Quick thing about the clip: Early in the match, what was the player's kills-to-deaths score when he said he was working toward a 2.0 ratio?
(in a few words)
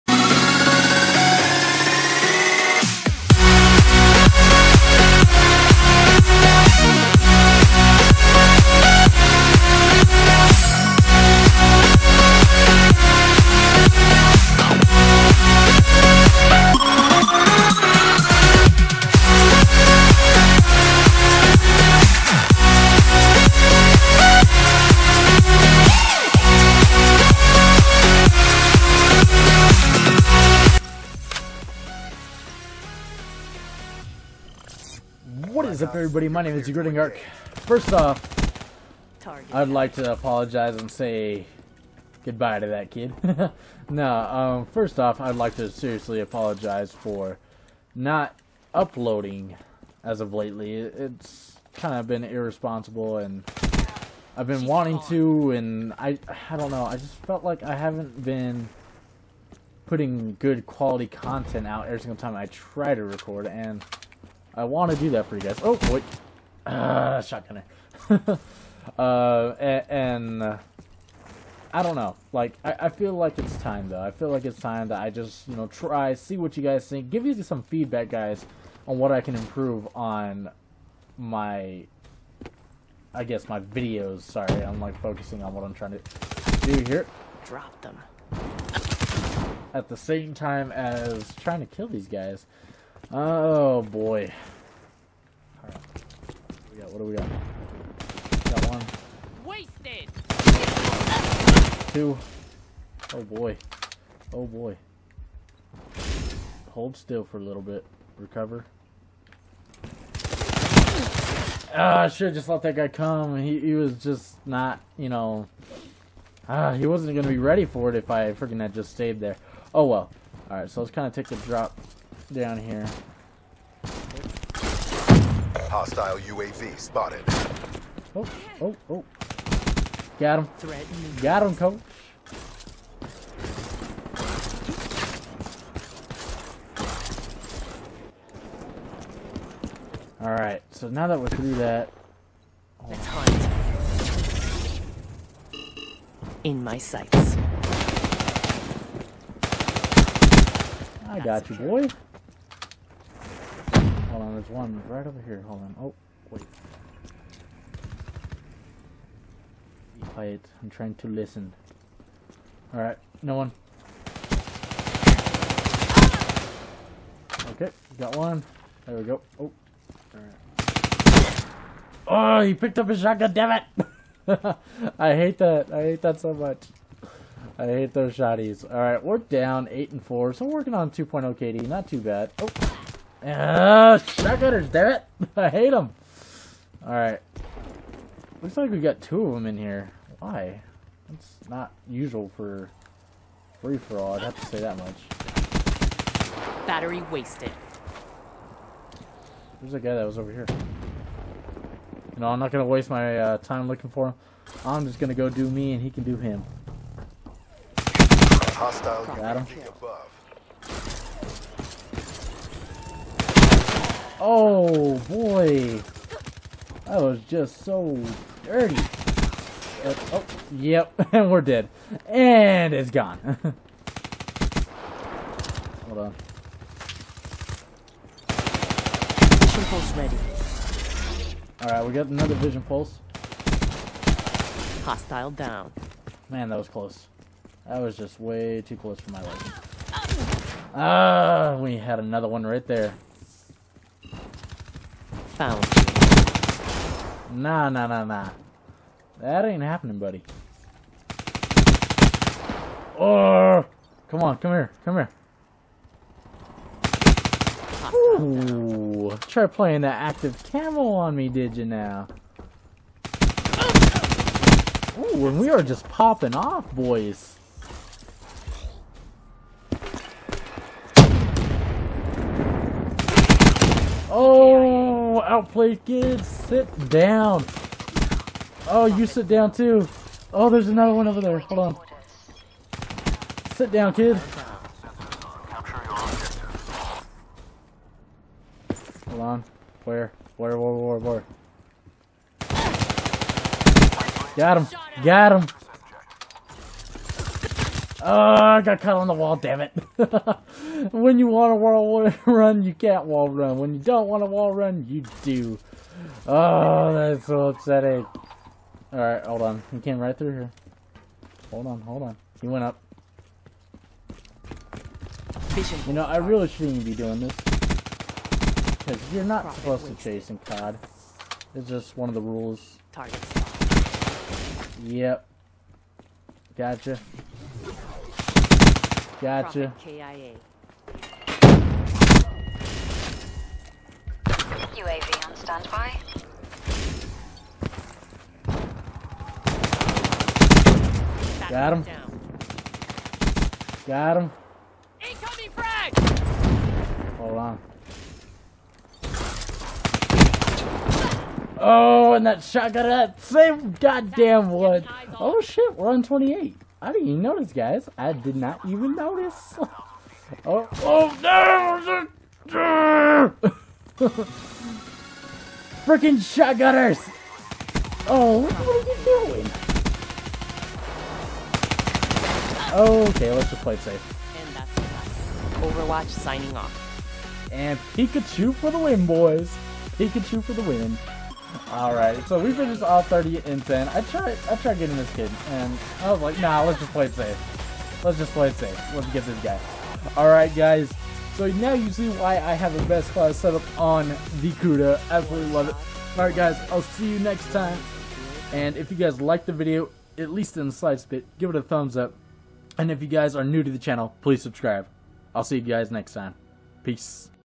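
8 and 4.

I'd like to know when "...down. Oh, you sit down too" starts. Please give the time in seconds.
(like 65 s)
276 s.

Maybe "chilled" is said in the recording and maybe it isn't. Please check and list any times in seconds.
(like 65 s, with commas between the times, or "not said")
not said.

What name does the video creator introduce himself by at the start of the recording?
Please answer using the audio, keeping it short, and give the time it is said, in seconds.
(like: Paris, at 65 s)
Degrading Arc, at 36 s.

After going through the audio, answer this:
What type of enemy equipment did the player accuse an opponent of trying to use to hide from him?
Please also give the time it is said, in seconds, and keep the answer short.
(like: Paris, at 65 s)
active camo, at 259 s.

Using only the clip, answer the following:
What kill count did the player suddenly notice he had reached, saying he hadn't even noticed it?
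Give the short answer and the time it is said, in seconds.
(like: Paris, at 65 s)
28, at 356 s.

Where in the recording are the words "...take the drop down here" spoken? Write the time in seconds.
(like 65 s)
121 s.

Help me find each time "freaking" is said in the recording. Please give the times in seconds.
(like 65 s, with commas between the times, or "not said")
118 s, 365 s.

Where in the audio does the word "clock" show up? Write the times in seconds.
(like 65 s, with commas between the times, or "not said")
not said.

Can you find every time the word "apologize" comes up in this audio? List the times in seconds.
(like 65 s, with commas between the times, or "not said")
40 s, 46 s.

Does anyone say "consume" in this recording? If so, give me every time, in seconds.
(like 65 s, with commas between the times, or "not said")
not said.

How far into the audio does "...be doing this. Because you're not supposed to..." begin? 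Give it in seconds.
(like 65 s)
316 s.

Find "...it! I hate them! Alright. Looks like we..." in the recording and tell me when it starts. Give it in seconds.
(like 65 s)
184 s.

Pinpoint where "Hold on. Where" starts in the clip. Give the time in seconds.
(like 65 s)
289 s.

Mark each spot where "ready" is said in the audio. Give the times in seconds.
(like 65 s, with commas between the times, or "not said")
117 s, 229 s.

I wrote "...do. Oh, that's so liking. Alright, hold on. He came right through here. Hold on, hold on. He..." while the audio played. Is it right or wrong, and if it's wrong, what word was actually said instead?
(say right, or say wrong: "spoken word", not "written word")
wrong: "upsetting", not "liking".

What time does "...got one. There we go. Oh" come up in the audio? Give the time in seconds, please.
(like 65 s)
167 s.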